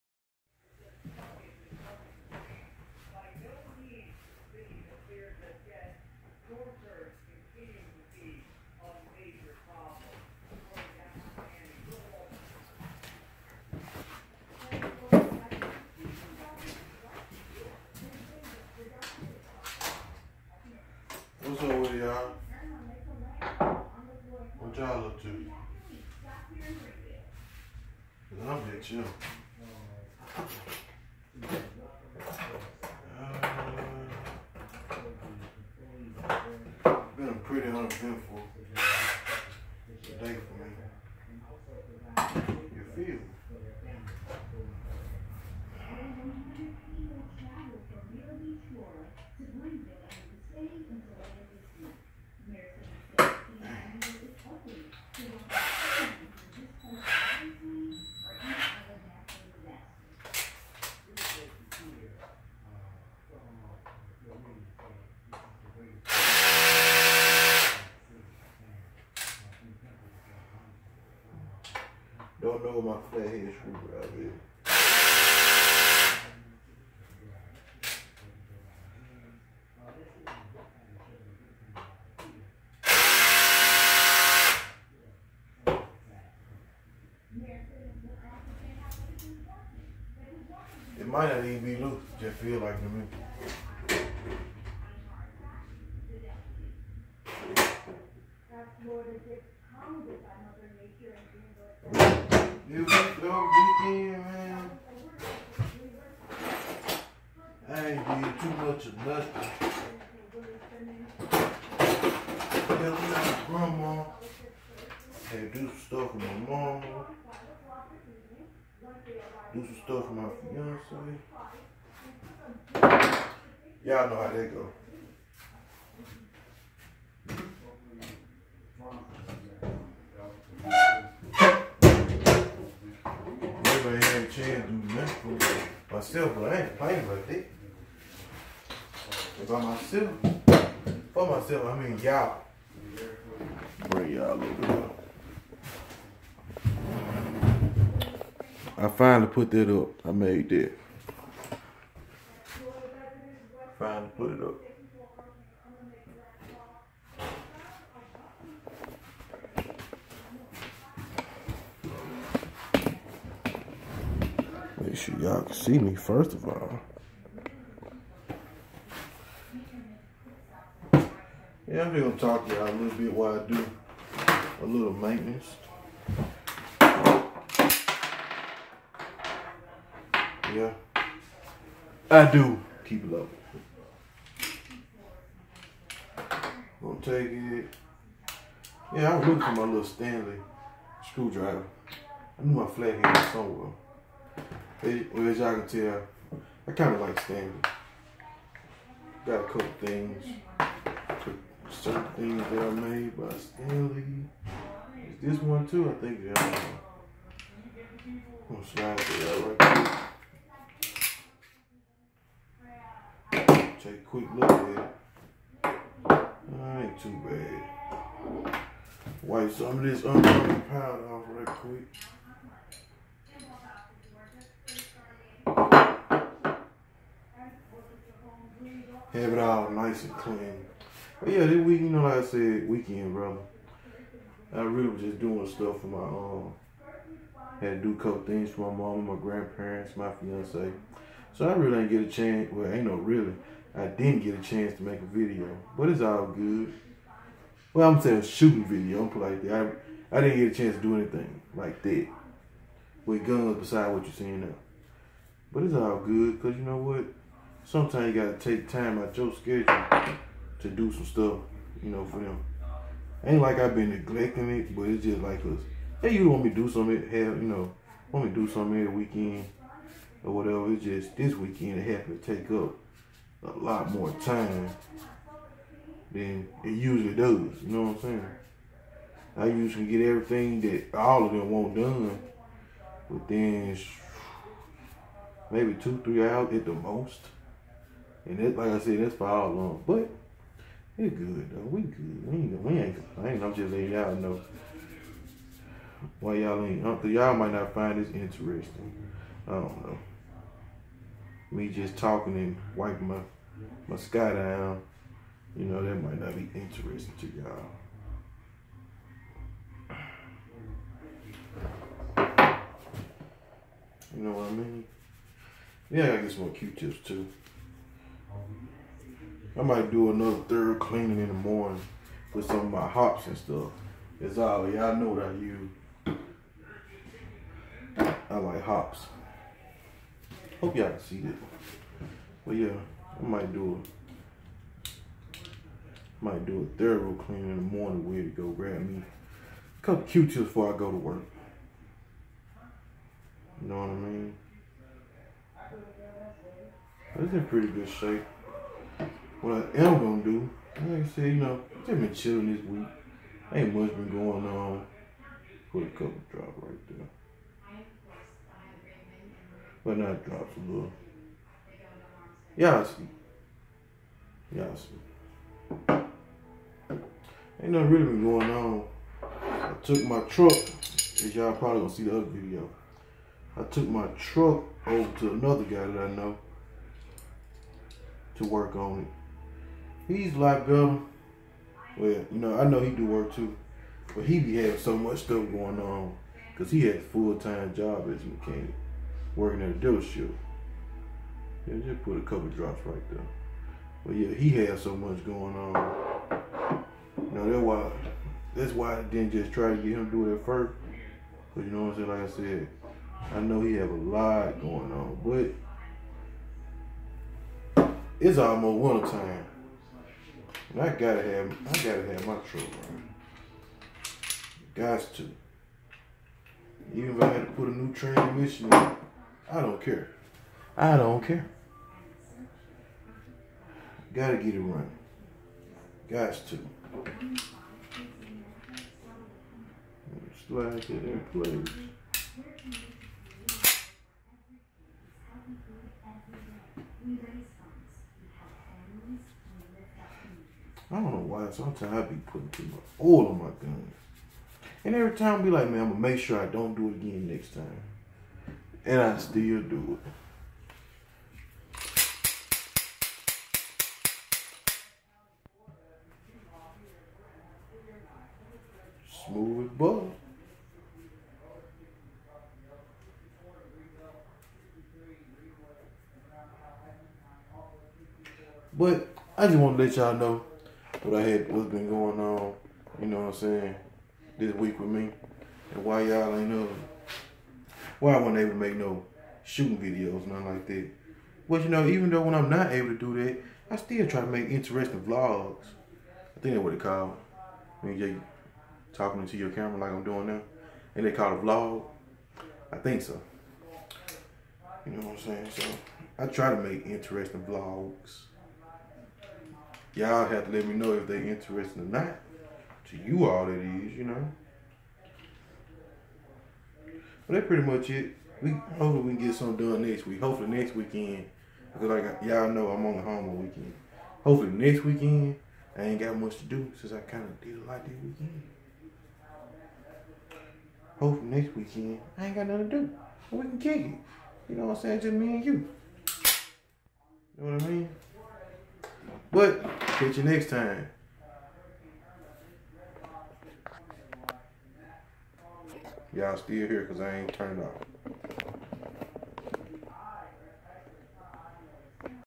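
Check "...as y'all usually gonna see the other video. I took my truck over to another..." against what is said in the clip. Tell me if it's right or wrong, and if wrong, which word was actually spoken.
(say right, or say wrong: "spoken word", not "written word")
wrong: "probably", not "usually".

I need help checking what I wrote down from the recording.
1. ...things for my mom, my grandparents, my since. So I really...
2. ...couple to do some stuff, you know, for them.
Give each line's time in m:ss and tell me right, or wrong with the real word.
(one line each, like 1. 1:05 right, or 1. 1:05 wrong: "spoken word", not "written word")
1. 3:58 wrong: "fiance", not "since"
2. 4:19 wrong: "schedule", not "couple".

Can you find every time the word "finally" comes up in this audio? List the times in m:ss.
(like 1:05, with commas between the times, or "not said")
2:28, 2:33.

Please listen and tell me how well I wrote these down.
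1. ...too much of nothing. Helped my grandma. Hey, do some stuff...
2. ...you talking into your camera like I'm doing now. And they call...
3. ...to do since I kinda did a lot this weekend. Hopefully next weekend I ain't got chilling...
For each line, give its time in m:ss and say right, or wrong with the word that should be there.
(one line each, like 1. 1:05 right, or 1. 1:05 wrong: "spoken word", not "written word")
1. 1:48 right
2. 8:07 right
3. 8:36 wrong: "nothing", not "chilling".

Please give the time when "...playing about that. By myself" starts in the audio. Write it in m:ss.
2:16.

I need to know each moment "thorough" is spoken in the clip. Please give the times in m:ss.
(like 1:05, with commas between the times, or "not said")
5:36.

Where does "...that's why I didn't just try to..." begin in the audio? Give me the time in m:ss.
6:38.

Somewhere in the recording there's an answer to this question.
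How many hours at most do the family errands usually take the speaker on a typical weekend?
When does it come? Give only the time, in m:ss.
4:46.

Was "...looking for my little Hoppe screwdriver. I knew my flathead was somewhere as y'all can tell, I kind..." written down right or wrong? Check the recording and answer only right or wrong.
wrong.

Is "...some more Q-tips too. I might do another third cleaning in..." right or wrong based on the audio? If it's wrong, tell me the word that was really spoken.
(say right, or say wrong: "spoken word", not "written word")
right.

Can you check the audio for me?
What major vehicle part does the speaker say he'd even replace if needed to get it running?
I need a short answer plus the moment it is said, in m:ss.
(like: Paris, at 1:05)
Transmission, at 6:57.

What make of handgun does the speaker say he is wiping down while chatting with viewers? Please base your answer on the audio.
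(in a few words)
SCCY.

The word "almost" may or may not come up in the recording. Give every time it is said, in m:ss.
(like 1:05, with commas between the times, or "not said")
6:48.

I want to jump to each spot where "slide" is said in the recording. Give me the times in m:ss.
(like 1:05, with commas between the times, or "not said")
3:28, 7:10.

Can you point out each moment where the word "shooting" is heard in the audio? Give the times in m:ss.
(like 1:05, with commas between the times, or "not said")
4:08, 7:59.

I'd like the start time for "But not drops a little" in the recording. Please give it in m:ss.
5:59.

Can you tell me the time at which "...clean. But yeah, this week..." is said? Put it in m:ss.
3:50.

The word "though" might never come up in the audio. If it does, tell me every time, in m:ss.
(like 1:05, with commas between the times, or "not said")
4:51, 8:02.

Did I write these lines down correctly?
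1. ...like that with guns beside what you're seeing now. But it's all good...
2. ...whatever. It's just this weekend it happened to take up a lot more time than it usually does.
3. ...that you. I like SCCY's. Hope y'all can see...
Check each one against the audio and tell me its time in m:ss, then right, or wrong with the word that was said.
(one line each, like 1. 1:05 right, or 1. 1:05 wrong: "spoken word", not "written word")
1. 4:11 right
2. 4:30 right
3. 5:25 wrong: "Hoppe", not "SCCY".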